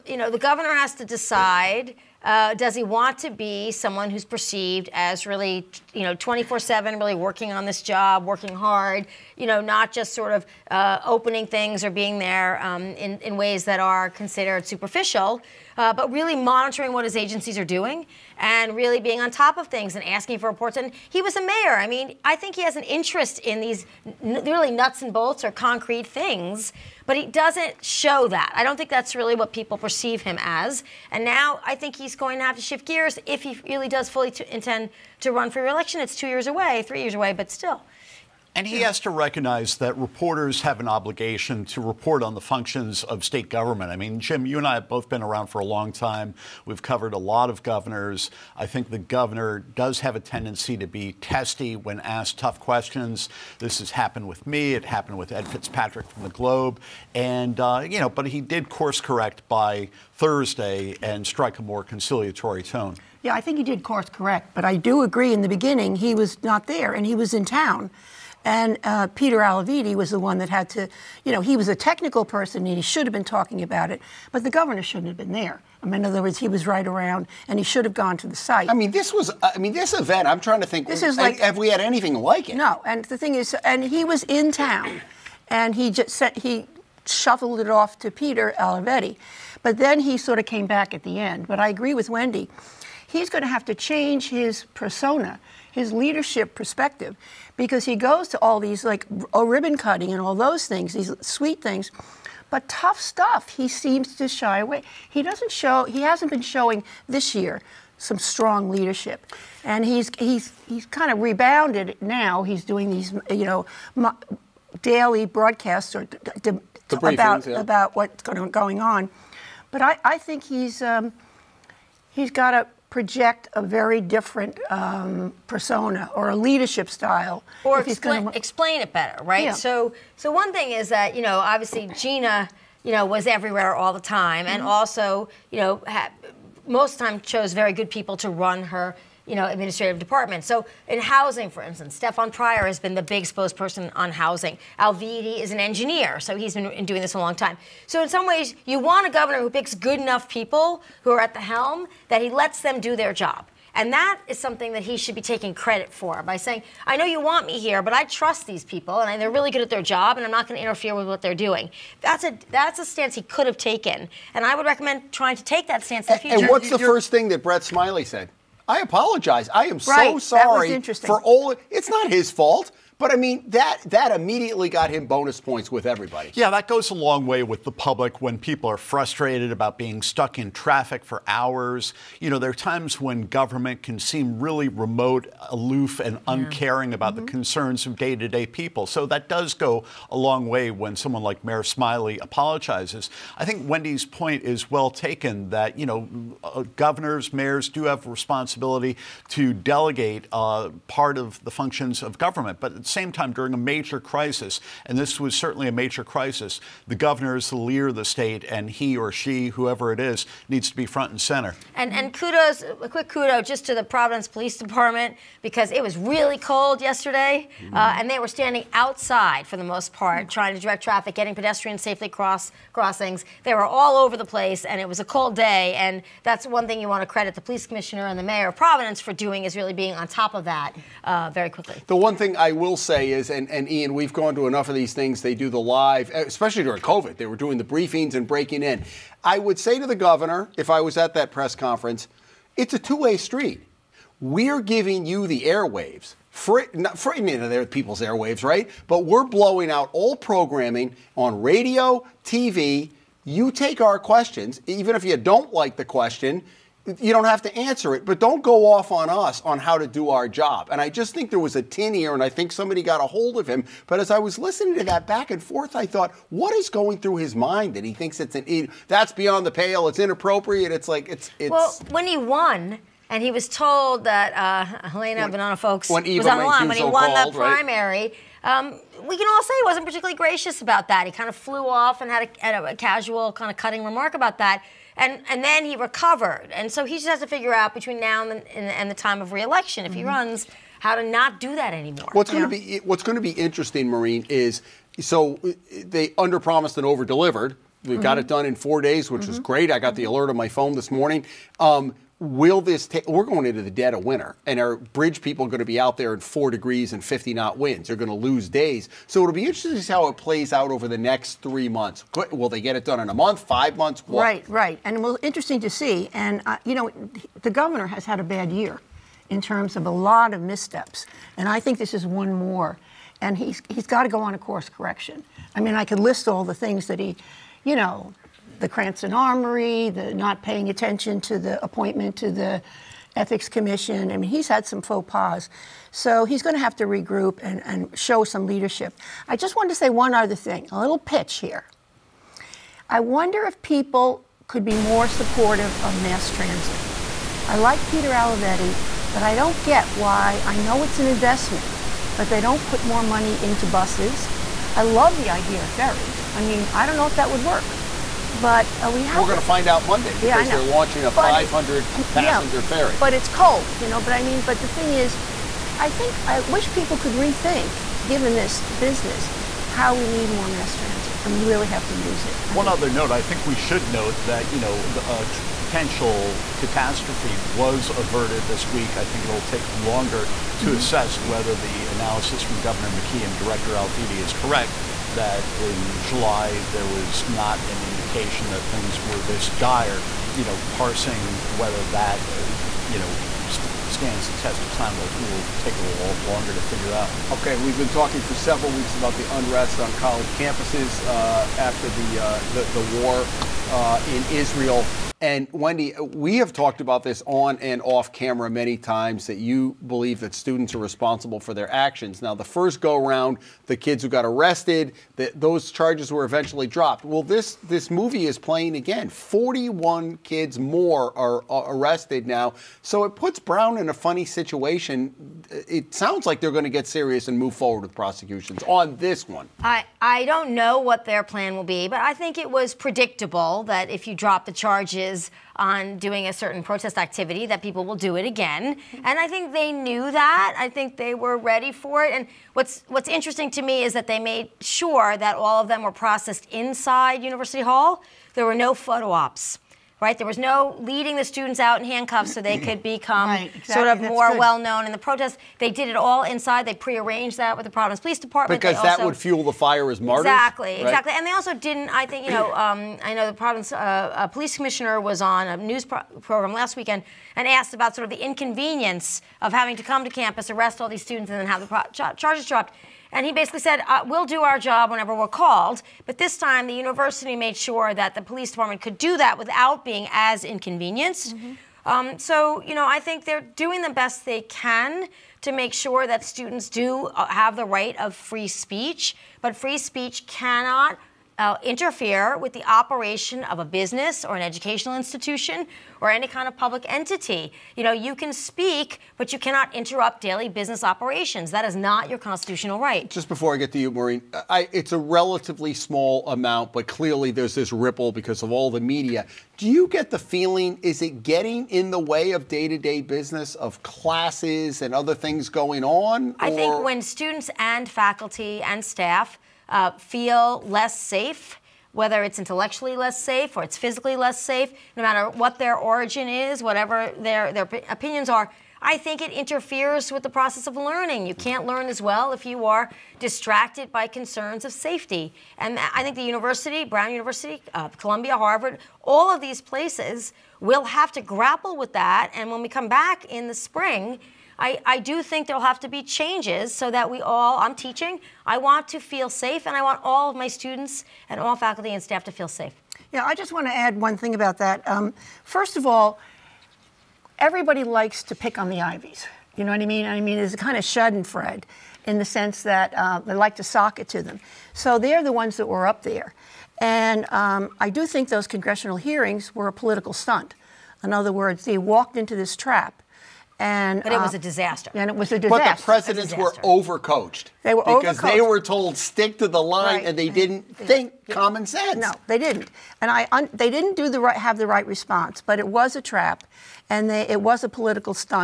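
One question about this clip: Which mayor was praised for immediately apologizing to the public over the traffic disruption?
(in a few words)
Brett Smiley.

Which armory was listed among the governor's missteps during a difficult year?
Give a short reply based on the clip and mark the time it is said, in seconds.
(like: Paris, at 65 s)
Cranston Armory, at 328 s.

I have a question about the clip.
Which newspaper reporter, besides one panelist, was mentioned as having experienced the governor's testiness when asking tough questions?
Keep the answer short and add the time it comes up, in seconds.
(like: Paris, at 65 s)
Ed Fitzpatrick, at 55 s.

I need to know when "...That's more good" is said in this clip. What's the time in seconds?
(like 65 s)
454 s.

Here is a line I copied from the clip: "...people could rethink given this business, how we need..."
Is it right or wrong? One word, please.
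right.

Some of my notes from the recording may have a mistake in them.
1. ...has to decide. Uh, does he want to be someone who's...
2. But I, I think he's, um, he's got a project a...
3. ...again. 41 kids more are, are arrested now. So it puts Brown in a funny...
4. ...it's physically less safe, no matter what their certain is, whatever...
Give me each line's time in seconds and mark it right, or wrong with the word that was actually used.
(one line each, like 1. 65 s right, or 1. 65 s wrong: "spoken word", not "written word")
1. 0 s right
2. 119 s right
3. 418 s right
4. 523 s wrong: "origin", not "certain".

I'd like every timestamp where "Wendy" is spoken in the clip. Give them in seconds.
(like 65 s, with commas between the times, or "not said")
92 s, 193 s, 405 s.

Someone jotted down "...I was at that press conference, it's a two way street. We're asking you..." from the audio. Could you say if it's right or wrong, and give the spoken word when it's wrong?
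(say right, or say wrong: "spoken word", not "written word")
wrong: "giving", not "asking".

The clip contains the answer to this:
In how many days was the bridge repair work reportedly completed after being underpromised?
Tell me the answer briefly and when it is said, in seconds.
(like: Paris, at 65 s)
4, at 298 s.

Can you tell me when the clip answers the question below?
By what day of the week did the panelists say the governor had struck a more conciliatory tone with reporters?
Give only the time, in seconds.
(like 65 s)
60 s.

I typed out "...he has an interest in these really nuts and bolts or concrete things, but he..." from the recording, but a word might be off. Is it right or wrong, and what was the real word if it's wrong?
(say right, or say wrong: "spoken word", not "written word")
right.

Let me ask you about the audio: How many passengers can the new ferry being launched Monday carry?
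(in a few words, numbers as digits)
500.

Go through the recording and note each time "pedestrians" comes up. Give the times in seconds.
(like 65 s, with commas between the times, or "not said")
221 s.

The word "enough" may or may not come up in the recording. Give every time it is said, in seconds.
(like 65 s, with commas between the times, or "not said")
150 s, 234 s.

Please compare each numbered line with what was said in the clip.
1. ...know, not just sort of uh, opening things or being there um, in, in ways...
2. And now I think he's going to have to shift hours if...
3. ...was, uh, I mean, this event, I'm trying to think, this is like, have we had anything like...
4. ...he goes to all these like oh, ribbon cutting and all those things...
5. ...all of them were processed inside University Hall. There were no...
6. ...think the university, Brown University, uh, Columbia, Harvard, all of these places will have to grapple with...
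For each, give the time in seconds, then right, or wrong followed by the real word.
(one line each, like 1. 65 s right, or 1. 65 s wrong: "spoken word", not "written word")
1. 9 s right
2. 31 s wrong: "gears", not "hours"
3. 79 s right
4. 97 s right
5. 445 s right
6. 536 s right.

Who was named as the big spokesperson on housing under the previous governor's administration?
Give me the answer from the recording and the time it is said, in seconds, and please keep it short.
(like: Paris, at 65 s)
Stefan Pryor, at 141 s.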